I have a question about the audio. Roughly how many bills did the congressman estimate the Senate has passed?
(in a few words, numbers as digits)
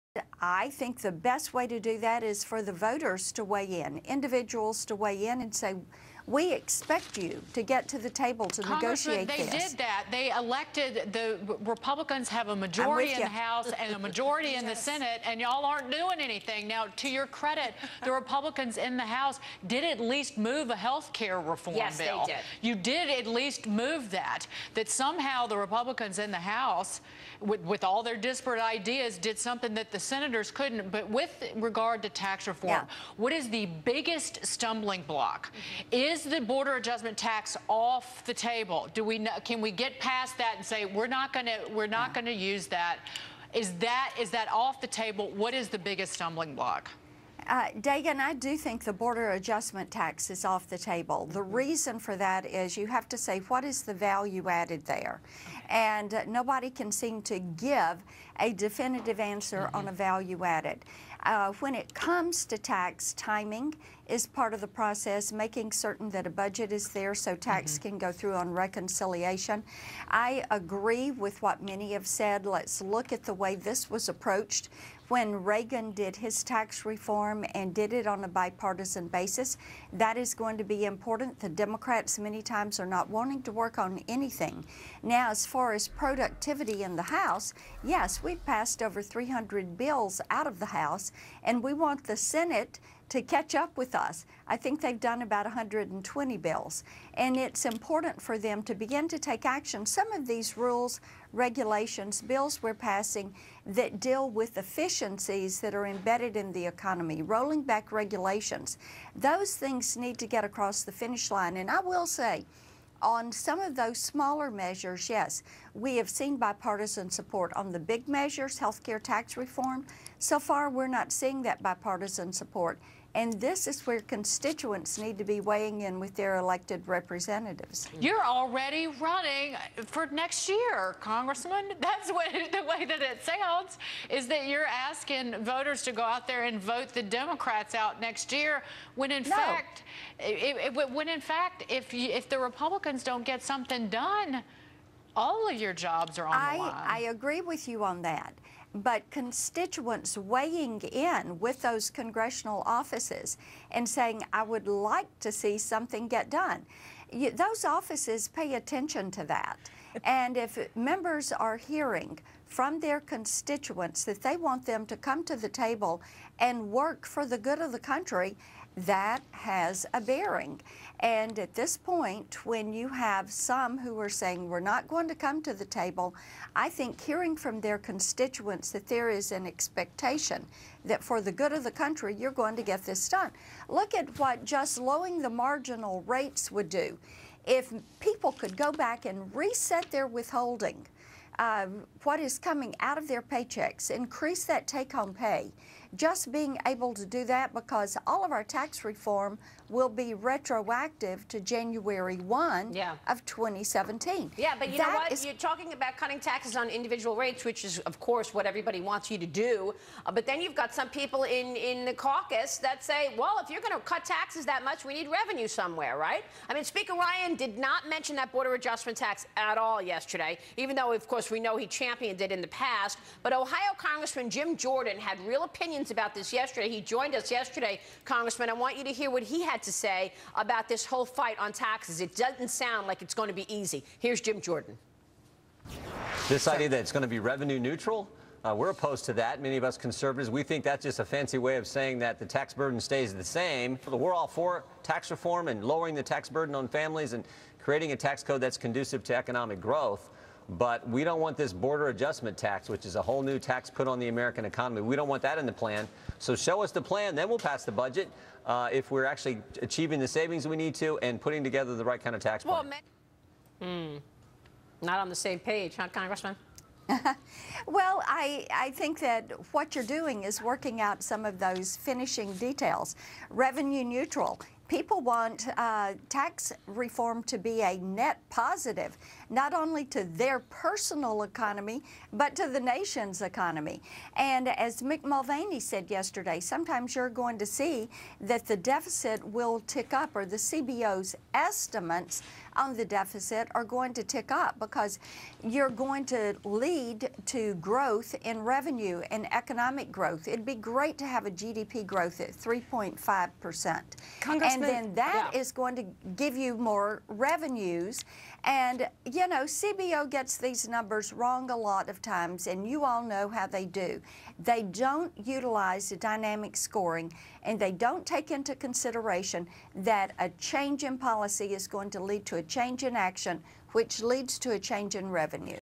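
120.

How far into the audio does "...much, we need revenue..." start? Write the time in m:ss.
3:34.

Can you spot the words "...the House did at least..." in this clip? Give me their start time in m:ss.
0:18.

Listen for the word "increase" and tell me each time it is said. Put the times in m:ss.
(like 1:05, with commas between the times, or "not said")
3:13.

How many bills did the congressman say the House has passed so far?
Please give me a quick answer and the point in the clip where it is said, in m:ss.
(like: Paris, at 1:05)
300, at 1:29.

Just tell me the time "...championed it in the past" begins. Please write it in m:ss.
3:41.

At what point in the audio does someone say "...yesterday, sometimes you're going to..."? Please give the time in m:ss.
4:45.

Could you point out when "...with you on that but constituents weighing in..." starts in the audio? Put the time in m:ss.
2:27.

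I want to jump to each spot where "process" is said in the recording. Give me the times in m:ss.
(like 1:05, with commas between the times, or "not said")
1:04.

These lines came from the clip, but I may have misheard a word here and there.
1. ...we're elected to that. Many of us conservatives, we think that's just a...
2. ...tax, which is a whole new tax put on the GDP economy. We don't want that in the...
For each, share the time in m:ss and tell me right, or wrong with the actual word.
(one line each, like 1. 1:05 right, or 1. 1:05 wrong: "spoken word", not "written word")
1. 3:58 wrong: "opposed", not "elected"
2. 4:12 wrong: "American", not "GDP".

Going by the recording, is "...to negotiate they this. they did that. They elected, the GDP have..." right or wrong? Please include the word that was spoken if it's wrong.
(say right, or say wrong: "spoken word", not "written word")
wrong: "Republicans", not "GDP".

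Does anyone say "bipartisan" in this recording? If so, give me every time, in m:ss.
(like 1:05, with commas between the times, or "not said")
1:18, 1:56, 2:01.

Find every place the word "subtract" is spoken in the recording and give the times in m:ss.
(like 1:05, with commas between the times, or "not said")
not said.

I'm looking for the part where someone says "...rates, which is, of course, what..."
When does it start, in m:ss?
3:27.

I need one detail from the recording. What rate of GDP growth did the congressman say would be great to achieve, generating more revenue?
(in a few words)
3.5%.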